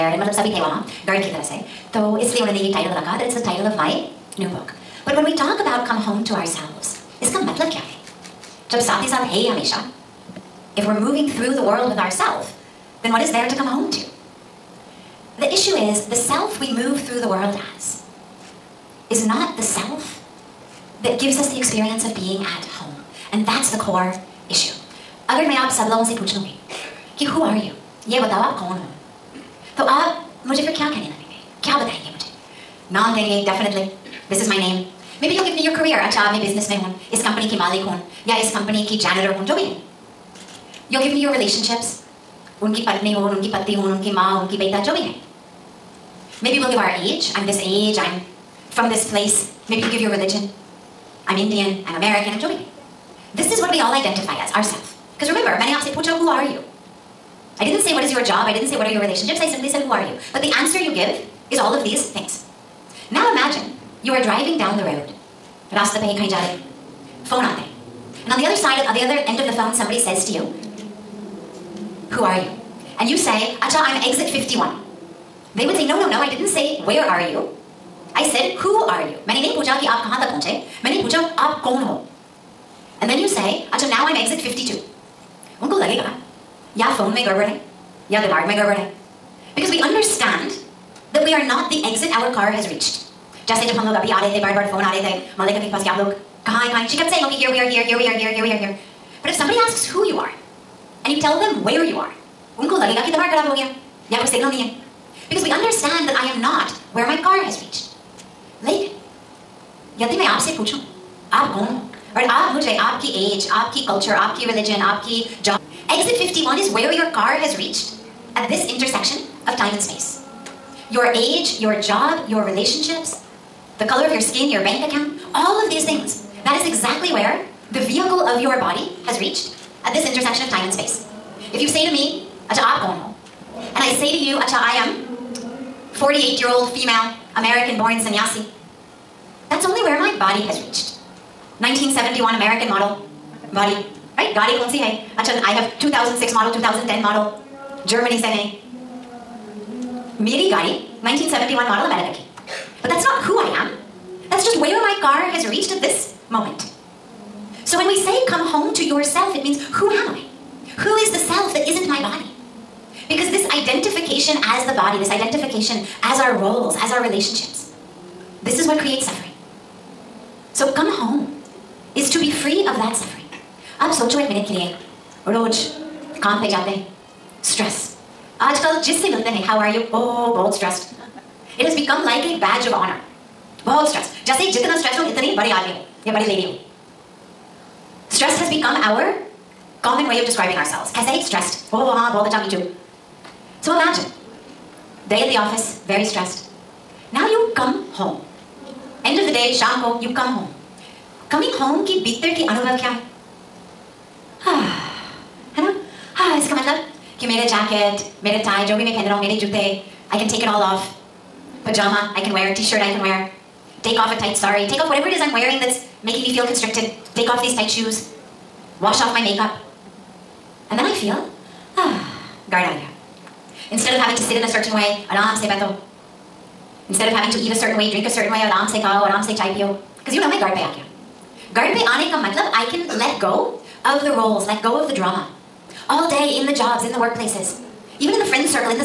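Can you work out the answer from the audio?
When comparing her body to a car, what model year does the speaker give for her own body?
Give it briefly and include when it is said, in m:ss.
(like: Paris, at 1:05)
1971, at 2:21.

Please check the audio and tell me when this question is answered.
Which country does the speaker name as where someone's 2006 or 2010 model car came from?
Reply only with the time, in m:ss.
2:27.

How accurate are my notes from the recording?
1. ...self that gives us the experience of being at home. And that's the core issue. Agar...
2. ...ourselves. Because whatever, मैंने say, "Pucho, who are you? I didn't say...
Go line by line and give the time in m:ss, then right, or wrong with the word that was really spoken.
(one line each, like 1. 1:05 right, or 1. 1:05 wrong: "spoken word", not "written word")
1. 0:19 right
2. 0:54 wrong: "remember", not "whatever".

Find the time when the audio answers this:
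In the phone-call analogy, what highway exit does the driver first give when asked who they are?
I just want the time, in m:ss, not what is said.
1:13.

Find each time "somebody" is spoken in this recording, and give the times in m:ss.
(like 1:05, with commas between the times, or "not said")
1:09, 1:39.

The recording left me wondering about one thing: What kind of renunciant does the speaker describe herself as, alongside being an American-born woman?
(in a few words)
Sannyasi.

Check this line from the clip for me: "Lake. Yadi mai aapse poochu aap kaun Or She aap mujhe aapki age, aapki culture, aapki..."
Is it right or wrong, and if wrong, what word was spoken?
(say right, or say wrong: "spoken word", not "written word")
wrong: "Aur", not "She".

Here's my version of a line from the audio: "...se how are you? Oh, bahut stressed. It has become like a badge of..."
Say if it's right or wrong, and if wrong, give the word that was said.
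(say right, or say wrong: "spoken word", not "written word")
right.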